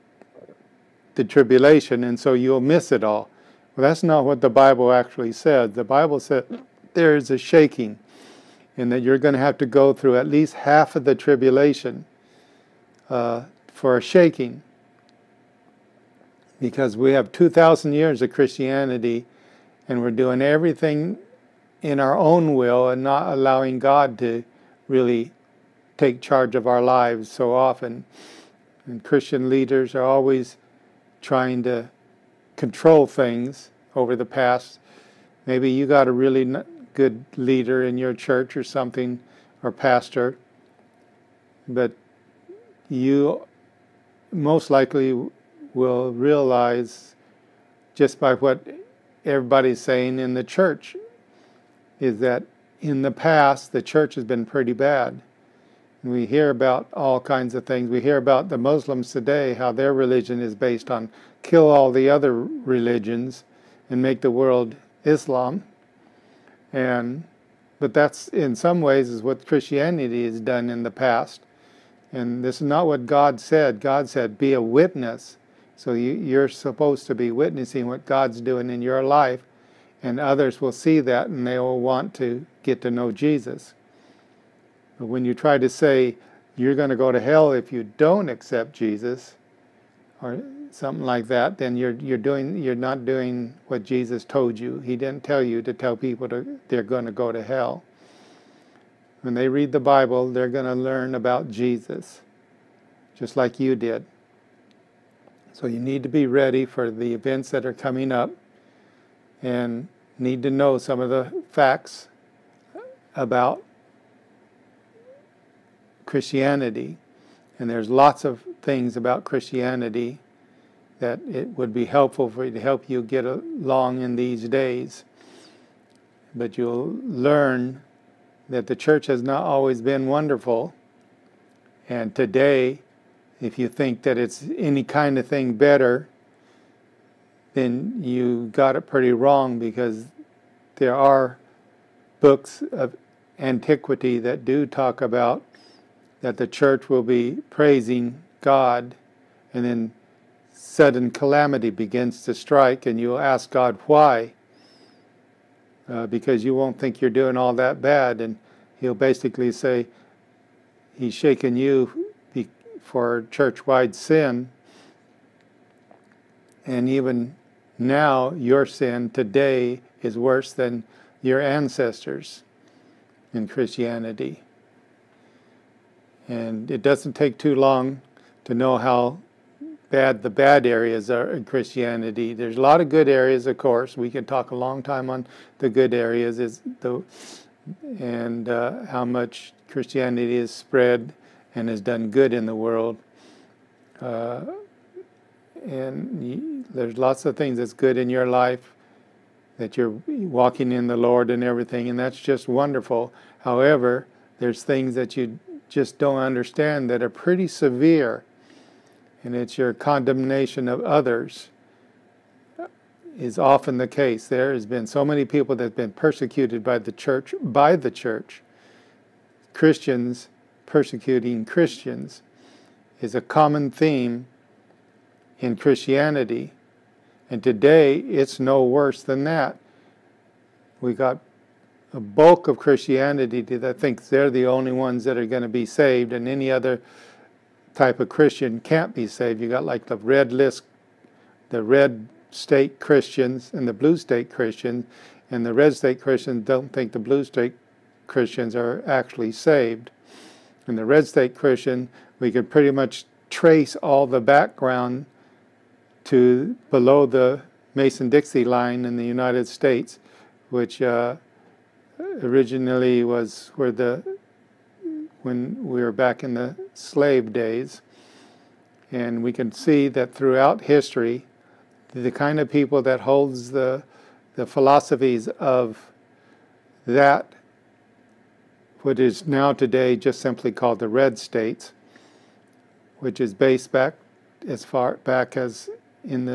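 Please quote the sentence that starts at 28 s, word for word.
And Christian leaders are always trying to control things over the past.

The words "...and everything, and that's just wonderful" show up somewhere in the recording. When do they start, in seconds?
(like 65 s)
201 s.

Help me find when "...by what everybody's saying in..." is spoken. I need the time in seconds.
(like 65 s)
48 s.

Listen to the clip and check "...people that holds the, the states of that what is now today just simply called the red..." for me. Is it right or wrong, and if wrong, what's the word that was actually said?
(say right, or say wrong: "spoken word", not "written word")
wrong: "philosophies", not "states".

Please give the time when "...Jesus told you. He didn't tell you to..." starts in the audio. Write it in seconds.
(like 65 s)
93 s.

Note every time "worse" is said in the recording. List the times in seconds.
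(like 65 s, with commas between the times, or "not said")
170 s, 228 s.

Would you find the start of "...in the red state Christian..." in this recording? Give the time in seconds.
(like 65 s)
250 s.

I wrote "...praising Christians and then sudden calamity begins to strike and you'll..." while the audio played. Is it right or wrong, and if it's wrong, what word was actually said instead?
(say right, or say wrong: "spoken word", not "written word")
wrong: "God", not "Christians".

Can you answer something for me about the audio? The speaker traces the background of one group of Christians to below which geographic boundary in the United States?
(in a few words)
Mason-Dixie line.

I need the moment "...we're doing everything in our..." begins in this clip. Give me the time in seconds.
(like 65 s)
19 s.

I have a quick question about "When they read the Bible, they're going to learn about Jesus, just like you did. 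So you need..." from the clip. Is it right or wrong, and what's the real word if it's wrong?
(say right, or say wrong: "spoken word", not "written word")
right.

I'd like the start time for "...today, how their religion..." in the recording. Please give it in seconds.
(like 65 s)
59 s.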